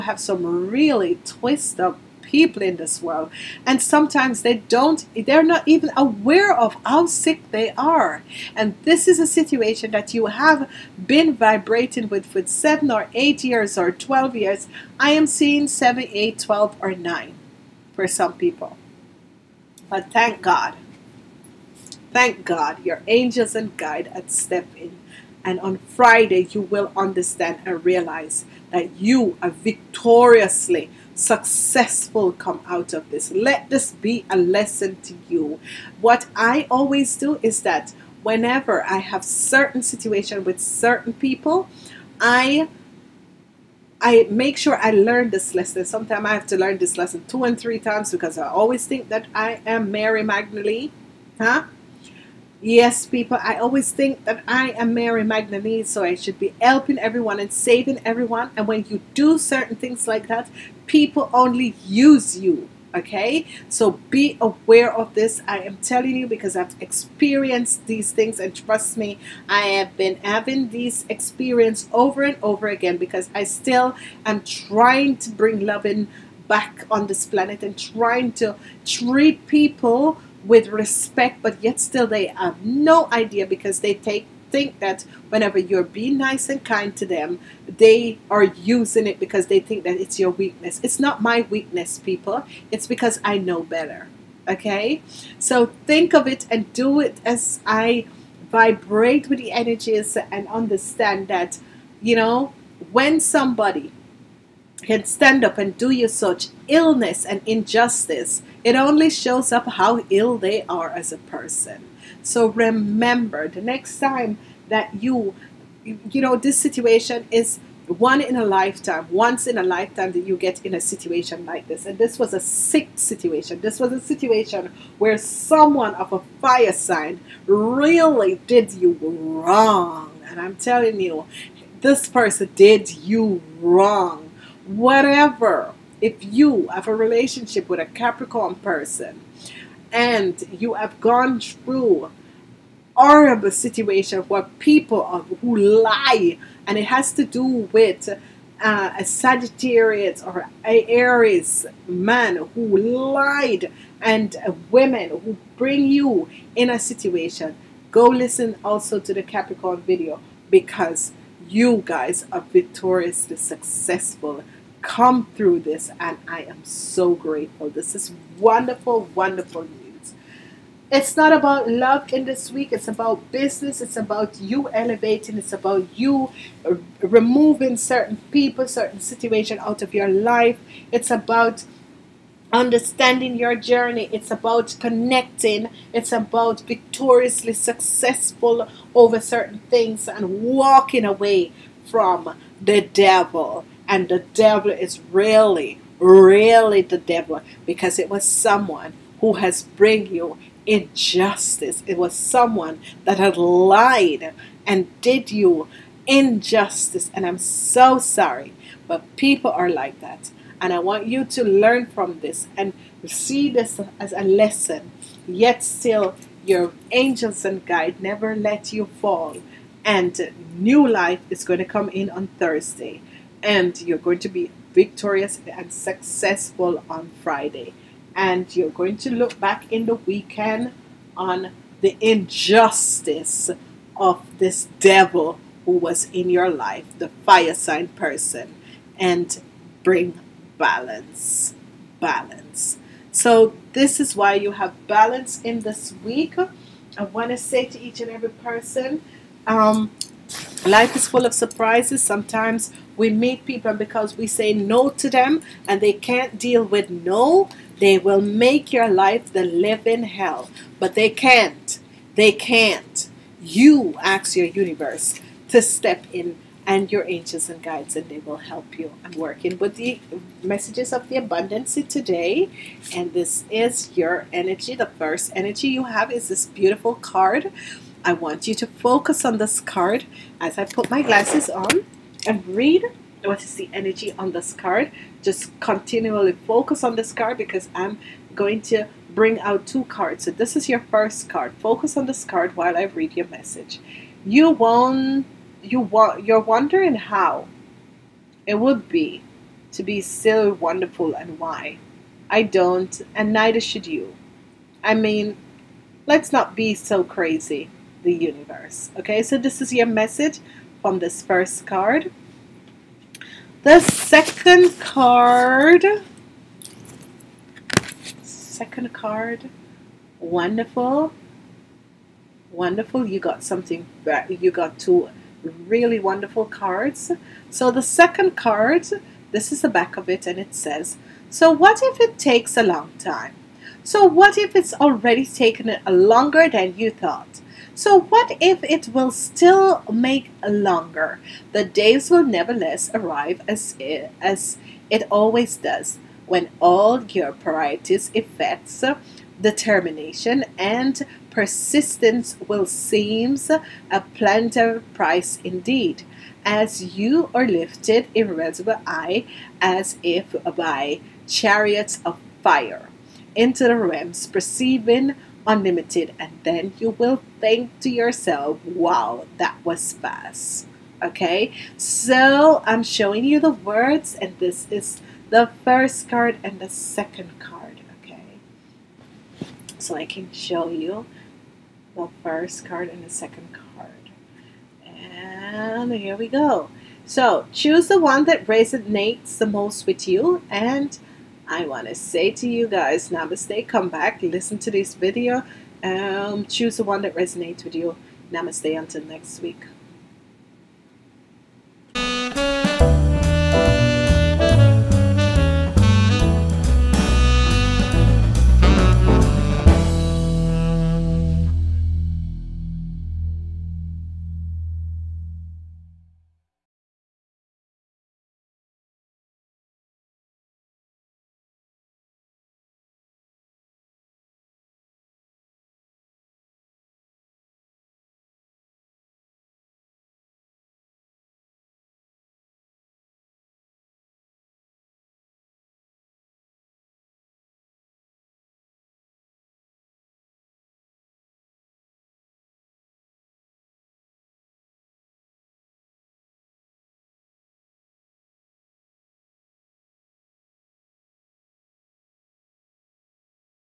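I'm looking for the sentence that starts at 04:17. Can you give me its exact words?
They will make your life the living hell.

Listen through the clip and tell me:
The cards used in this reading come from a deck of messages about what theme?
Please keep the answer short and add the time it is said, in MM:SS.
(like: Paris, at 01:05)
abundance, at 04:31.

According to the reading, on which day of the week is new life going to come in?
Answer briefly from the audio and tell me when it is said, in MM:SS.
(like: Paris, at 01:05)
Thursday, at 03:42.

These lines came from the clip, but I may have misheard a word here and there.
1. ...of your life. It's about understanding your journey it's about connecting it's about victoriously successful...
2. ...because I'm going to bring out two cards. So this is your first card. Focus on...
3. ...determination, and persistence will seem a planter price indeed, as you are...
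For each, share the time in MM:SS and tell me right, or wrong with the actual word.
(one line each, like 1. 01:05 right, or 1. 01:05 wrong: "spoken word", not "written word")
1. 02:59 right
2. 04:47 right
3. 05:49 right.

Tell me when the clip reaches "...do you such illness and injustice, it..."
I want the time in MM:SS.
01:45.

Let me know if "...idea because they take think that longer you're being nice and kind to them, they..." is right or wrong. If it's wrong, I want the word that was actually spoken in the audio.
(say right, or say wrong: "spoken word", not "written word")
wrong: "whenever", not "longer".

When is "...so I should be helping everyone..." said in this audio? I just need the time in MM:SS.
00:55.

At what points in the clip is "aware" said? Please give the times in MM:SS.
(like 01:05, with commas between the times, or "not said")
00:05, 01:04.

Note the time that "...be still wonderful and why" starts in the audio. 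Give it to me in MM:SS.
04:59.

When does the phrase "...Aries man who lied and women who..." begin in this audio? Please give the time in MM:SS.
02:30.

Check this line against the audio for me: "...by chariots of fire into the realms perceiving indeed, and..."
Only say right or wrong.
wrong.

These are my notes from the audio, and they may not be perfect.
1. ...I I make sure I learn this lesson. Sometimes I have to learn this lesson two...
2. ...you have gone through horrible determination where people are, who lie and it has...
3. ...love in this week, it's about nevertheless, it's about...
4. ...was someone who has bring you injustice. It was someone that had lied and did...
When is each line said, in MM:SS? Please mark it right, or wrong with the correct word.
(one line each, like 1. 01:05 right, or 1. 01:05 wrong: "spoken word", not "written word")
1. 00:42 right
2. 02:20 wrong: "situation", not "determination"
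3. 02:51 wrong: "business", not "nevertheless"
4. 03:18 right.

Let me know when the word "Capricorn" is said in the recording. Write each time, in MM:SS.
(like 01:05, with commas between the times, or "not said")
02:17, 02:39.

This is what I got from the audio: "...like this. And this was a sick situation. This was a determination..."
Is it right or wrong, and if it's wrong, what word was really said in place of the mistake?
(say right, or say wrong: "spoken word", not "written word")
wrong: "situation", not "determination".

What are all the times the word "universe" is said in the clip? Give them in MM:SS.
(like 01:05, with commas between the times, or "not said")
04:24, 05:08.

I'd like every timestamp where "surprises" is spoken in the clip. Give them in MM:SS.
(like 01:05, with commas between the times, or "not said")
04:11.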